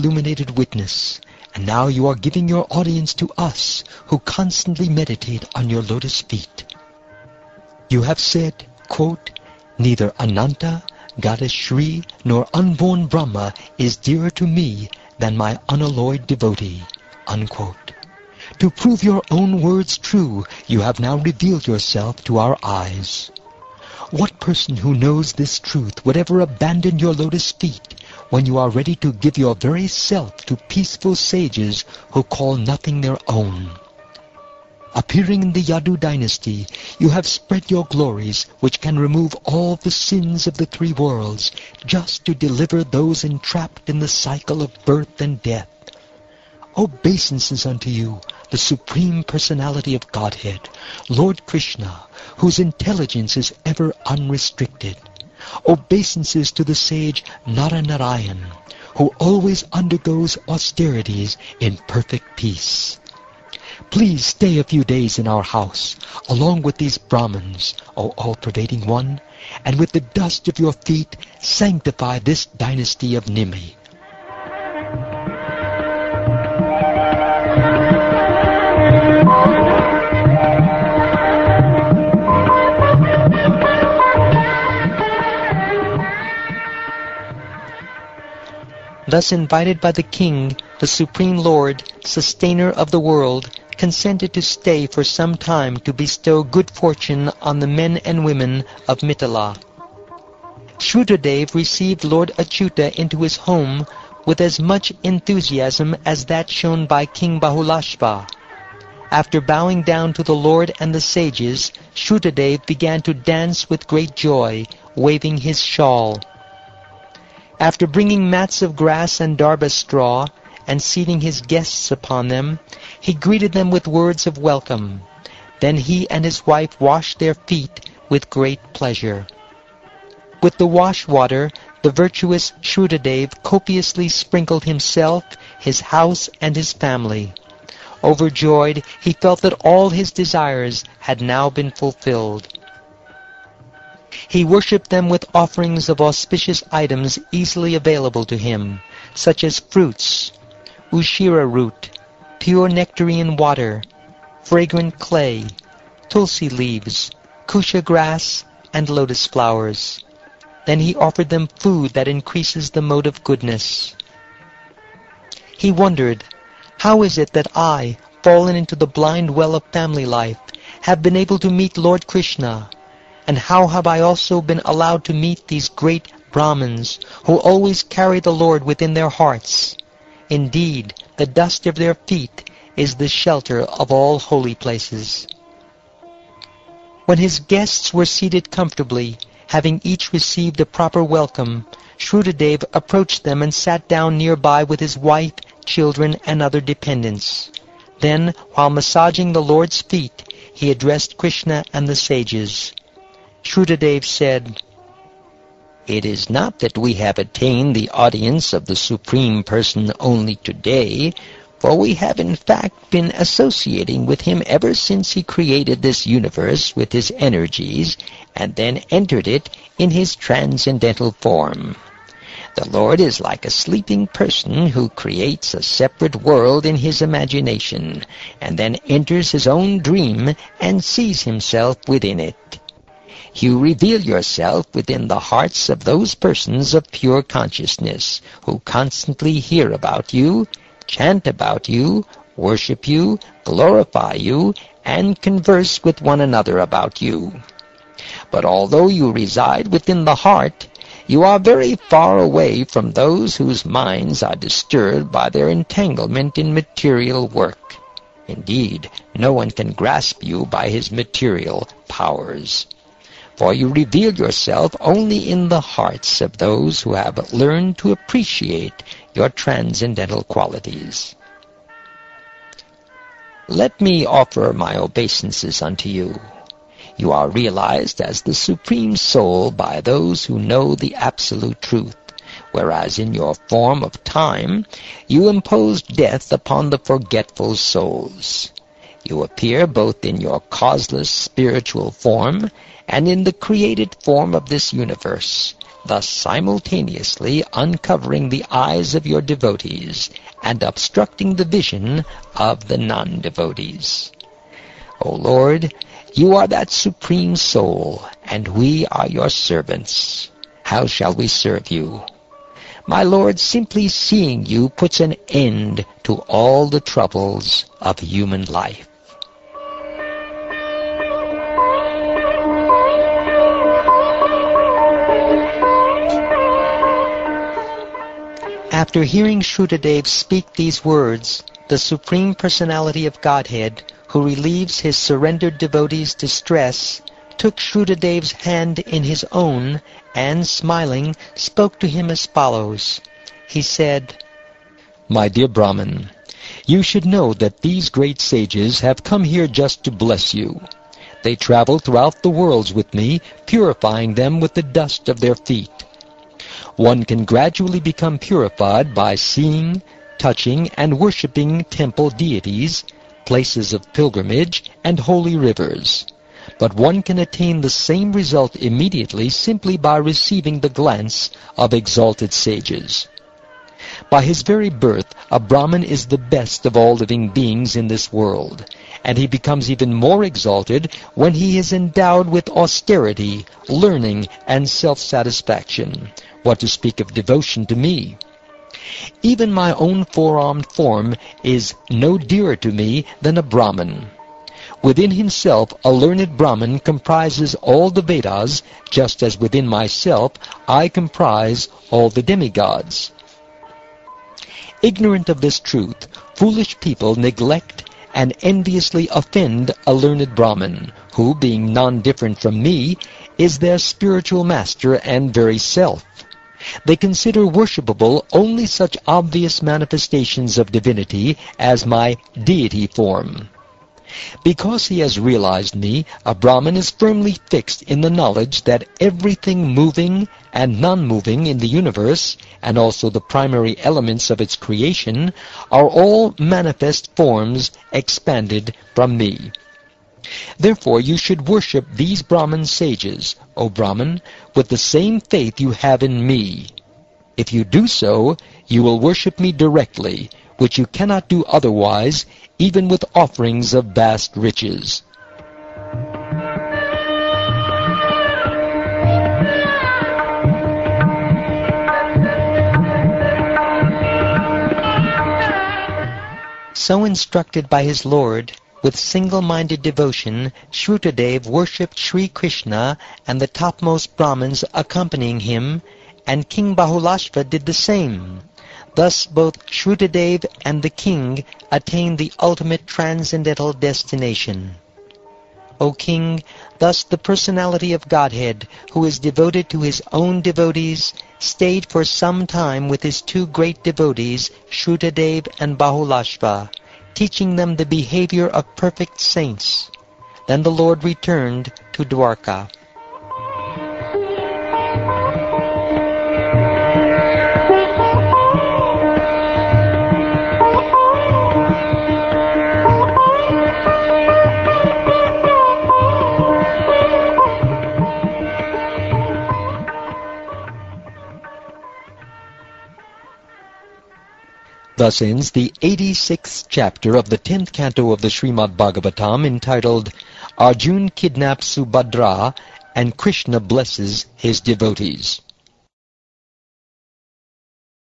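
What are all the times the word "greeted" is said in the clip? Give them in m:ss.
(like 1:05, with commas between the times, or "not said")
2:03.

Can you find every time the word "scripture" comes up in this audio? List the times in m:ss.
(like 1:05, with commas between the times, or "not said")
not said.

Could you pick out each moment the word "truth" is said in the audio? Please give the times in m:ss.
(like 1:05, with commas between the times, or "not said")
0:25, 4:41, 6:45.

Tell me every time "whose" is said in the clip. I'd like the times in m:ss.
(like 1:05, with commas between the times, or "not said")
0:52, 4:13.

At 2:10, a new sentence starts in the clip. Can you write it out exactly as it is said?
With the wash water, the virtuous Shrutadeva copiously sprinkled himself, his house, and his family.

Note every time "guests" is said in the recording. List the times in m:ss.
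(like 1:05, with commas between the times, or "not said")
2:01, 3:07.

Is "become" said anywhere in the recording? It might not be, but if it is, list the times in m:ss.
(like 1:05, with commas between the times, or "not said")
5:57, 6:19.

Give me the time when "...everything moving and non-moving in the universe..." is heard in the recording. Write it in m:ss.
7:08.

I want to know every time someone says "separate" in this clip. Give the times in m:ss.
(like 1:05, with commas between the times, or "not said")
3:45.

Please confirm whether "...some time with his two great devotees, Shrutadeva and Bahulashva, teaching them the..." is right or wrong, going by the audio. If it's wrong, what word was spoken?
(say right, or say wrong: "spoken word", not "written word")
right.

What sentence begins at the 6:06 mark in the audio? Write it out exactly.
But one can attain the same result immediately simply by receiving the glance of exalted sages.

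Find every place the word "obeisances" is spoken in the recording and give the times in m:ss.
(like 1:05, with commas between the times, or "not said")
0:46, 0:55, 4:34.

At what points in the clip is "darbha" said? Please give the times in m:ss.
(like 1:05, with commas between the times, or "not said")
1:59.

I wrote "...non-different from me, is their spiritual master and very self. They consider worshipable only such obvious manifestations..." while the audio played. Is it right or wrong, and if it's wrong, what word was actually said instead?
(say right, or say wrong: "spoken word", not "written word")
right.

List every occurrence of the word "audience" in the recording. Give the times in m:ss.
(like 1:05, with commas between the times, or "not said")
0:02, 3:27.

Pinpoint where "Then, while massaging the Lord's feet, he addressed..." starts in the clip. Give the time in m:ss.
3:17.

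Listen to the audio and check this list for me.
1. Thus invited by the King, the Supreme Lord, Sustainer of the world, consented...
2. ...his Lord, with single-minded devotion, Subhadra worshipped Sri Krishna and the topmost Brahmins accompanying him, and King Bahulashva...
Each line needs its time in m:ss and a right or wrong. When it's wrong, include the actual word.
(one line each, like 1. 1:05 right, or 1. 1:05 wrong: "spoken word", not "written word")
1. 1:29 right
2. 7:47 wrong: "Shrutadev", not "Subhadra".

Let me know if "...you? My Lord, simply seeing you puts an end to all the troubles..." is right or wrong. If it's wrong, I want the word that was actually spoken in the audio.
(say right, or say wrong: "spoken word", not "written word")
right.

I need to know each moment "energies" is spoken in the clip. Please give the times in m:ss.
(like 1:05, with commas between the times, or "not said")
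3:37.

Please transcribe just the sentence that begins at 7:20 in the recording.
Therefore you should worship these Brahman sages, O Brahman, with the same faith you have in me.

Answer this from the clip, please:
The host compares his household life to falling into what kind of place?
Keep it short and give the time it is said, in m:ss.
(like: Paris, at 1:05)
Blind well, at 2:48.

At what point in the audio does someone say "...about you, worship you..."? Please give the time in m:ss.
4:01.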